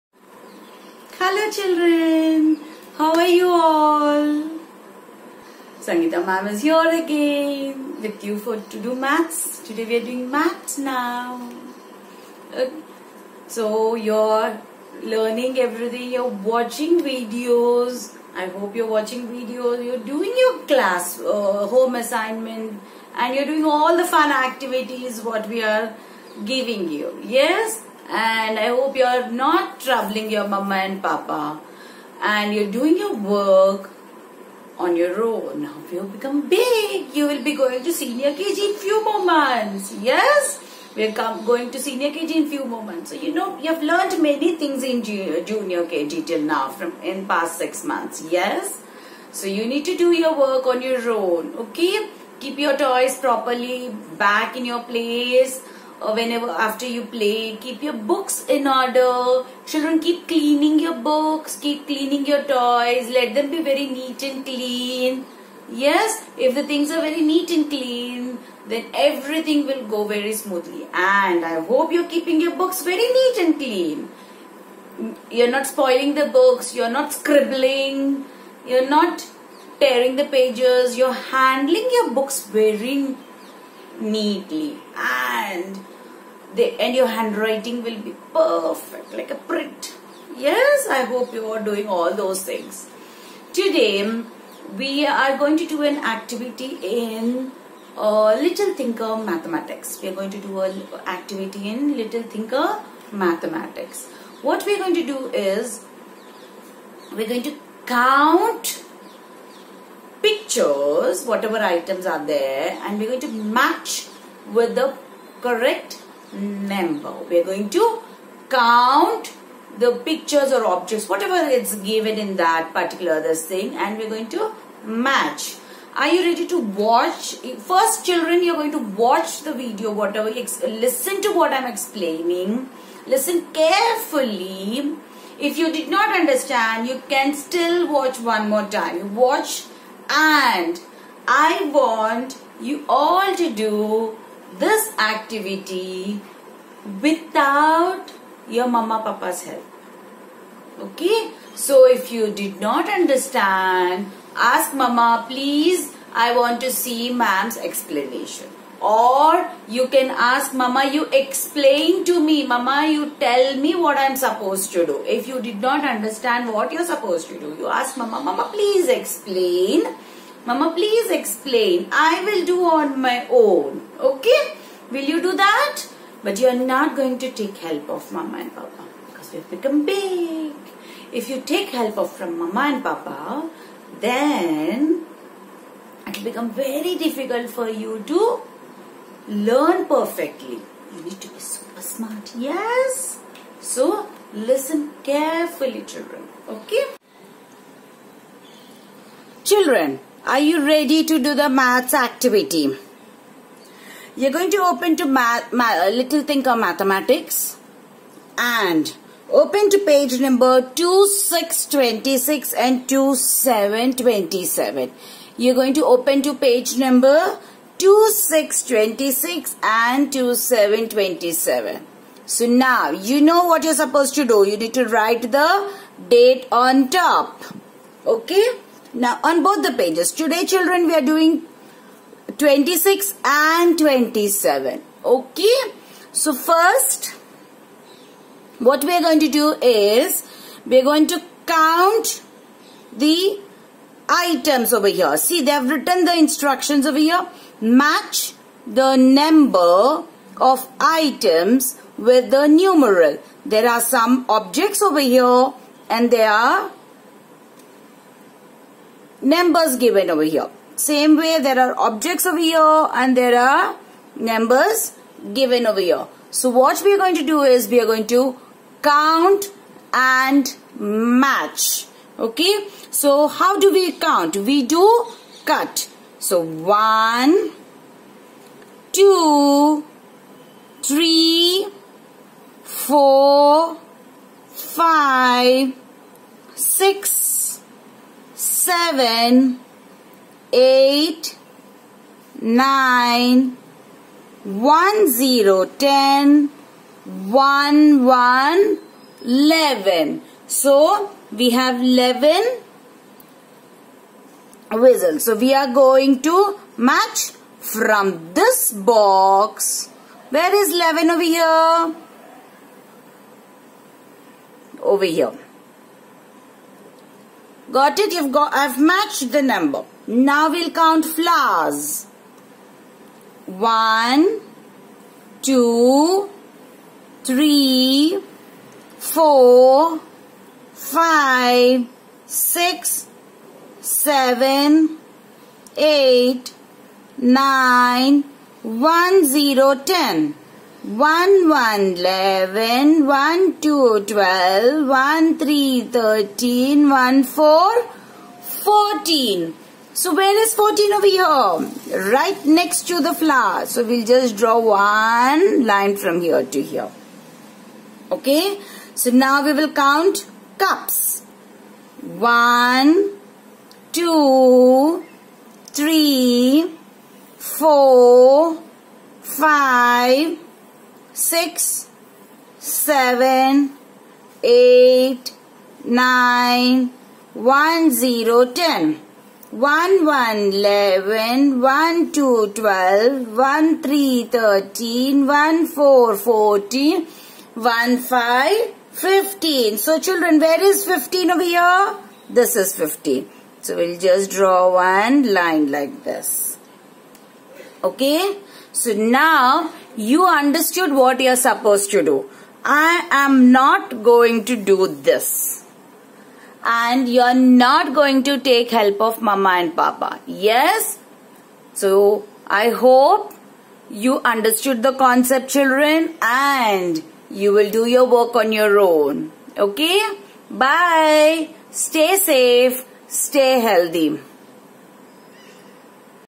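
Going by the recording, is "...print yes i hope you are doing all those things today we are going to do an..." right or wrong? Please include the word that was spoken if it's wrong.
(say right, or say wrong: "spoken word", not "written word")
right.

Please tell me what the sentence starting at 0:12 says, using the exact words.
Uh, so you're learning everything, you're watching videos.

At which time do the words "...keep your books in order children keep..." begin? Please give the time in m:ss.
0:57.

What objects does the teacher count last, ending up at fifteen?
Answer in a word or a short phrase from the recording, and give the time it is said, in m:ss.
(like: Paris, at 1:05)
Cups, at 6:00.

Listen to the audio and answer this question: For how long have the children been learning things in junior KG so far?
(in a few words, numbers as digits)
Six months.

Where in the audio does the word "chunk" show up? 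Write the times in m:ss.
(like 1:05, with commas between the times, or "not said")
not said.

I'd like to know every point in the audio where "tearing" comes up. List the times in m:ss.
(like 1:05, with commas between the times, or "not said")
1:19.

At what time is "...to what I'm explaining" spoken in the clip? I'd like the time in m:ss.
2:11.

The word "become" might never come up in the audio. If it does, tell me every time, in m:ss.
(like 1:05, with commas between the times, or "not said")
0:36, 2:59, 3:06.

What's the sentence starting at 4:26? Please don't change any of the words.
So what we are going to do is we are going to count and match.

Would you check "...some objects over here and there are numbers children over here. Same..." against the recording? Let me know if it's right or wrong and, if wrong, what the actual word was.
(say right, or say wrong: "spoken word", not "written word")
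wrong: "given", not "children".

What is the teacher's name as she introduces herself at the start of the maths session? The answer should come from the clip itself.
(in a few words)
Sangeeta.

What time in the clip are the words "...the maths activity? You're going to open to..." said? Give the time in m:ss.
3:21.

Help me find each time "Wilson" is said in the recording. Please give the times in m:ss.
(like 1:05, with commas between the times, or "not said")
not said.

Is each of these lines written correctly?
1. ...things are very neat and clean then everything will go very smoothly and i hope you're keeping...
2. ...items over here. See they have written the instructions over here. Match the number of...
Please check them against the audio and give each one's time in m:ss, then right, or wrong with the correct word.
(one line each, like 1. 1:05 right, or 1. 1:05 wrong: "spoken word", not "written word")
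1. 1:06 right
2. 4:04 right.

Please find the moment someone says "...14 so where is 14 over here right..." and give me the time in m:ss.
5:47.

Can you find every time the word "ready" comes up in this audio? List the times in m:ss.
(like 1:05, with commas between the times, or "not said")
2:06, 3:20.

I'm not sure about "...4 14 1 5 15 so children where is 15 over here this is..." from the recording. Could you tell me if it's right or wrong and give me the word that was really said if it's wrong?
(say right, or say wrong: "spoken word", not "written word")
right.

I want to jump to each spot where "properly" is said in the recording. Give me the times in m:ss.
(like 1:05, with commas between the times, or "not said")
0:53.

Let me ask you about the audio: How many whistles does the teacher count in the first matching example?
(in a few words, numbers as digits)
11.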